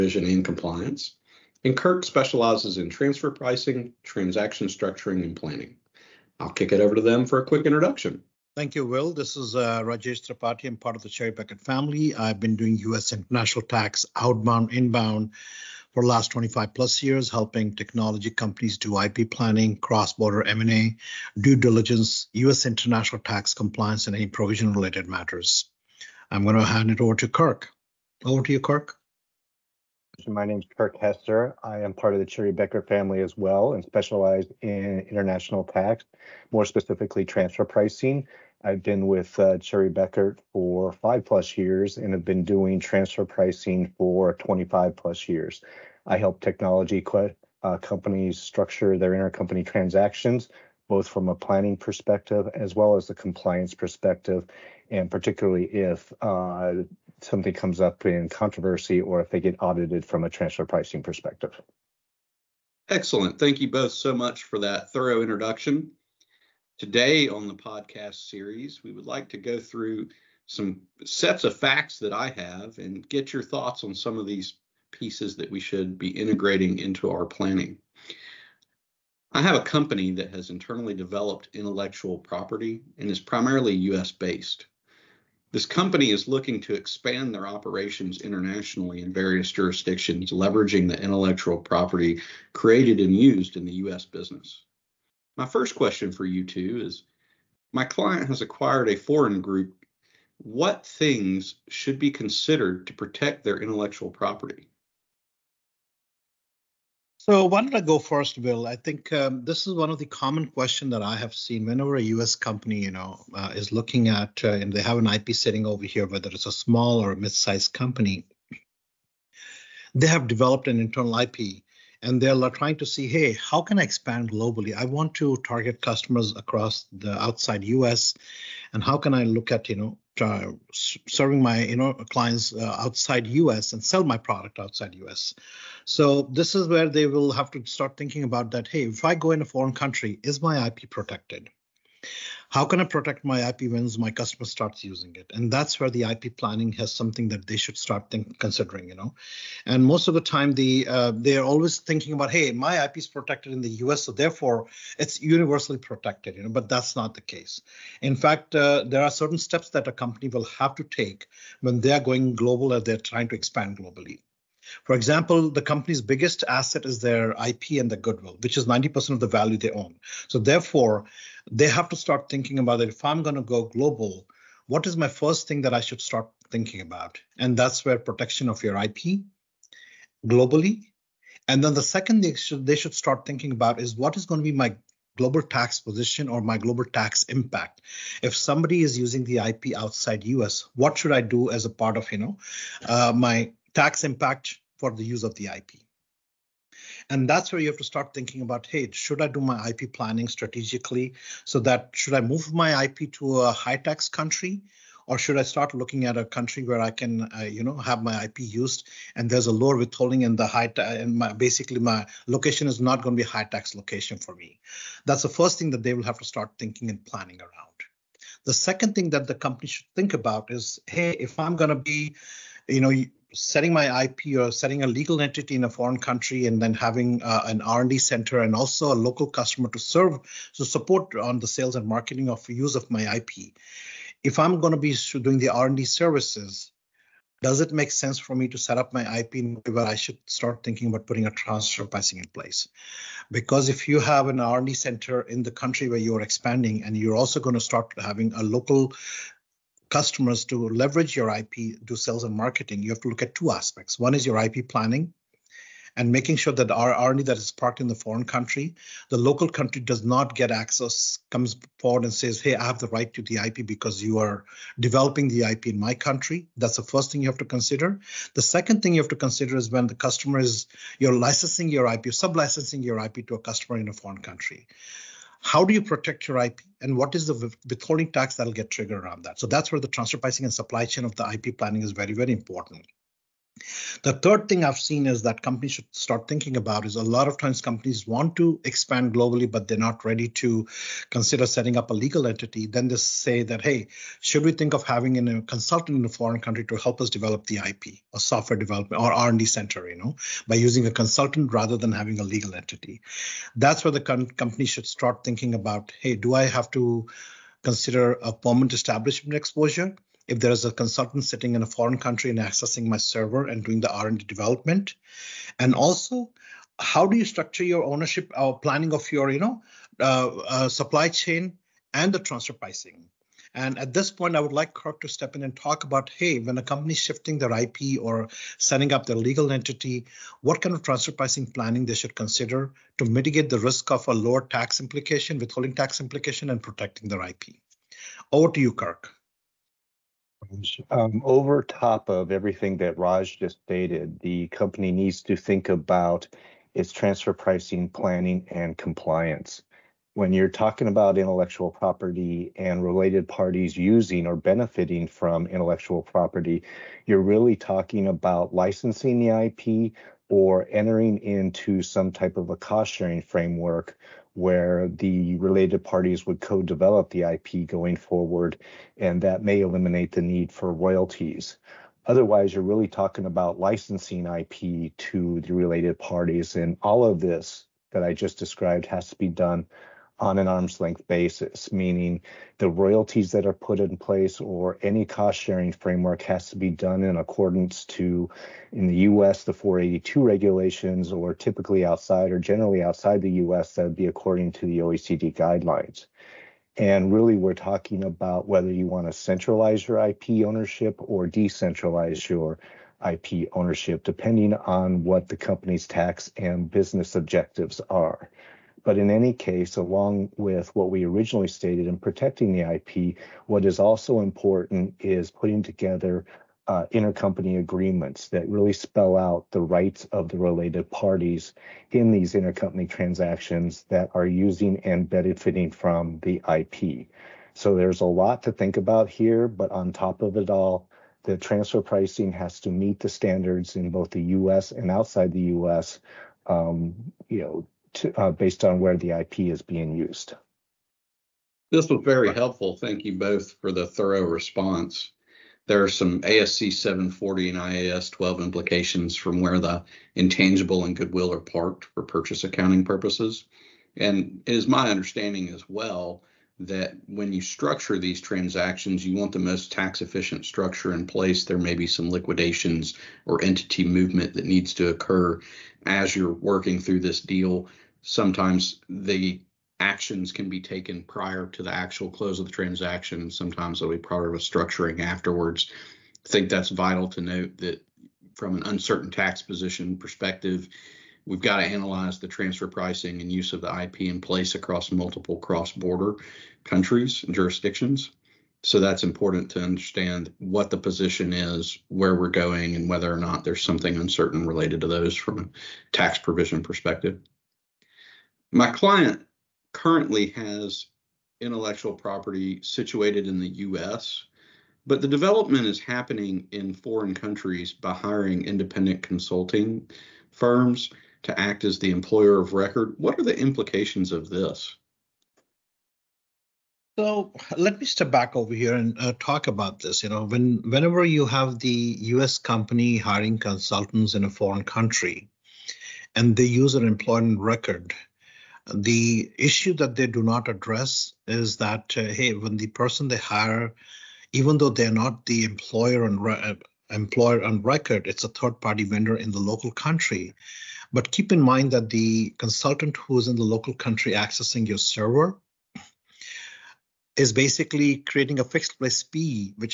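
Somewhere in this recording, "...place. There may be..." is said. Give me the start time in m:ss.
7:41.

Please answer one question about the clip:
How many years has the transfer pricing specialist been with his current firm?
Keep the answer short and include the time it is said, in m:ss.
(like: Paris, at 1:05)
5 plus years, at 0:40.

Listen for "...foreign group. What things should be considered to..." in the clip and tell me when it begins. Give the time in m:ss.
1:38.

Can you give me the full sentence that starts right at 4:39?
So that's where the transfer pricing and supply chain of the IP planning is very, very important.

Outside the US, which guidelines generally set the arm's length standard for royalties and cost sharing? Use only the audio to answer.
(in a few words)
OECD guidelines.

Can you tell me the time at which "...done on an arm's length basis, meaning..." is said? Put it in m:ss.
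6:19.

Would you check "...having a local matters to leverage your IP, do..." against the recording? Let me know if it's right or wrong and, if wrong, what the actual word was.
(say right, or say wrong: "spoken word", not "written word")
wrong: "customers", not "matters".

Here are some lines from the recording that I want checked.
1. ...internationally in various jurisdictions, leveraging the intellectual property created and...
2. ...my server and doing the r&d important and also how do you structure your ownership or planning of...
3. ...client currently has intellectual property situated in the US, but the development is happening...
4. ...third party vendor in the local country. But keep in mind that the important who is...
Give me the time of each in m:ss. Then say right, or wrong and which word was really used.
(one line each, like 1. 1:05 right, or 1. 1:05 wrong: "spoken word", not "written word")
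1. 1:28 right
2. 5:12 wrong: "development", not "important"
3. 8:18 right
4. 8:58 wrong: "consultant", not "important".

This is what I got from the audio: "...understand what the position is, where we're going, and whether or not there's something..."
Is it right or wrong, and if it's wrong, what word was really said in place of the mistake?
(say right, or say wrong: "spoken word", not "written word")
right.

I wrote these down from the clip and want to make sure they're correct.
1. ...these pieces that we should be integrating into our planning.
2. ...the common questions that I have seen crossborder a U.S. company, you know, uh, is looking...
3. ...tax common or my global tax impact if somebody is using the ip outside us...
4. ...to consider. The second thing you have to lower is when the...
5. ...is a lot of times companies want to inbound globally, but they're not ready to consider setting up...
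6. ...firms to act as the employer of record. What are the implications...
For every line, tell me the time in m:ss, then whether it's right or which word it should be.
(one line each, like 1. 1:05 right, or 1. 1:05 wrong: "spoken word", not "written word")
1. 1:14 right
2. 1:49 wrong: "whenever", not "crossborder"
3. 3:05 wrong: "position", not "common"
4. 4:27 wrong: "consider", not "lower"
5. 4:46 wrong: "expand", not "inbound"
6. 8:30 right.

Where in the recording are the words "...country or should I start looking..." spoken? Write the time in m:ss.
3:24.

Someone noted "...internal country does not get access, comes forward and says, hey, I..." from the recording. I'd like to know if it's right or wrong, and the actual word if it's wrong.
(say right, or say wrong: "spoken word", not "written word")
wrong: "local", not "internal".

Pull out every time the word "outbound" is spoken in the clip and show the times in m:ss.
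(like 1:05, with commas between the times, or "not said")
0:14.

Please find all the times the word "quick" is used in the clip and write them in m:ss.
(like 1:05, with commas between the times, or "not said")
0:07.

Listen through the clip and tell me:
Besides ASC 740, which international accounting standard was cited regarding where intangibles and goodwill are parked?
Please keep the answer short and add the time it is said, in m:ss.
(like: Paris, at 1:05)
IAS 12, at 7:27.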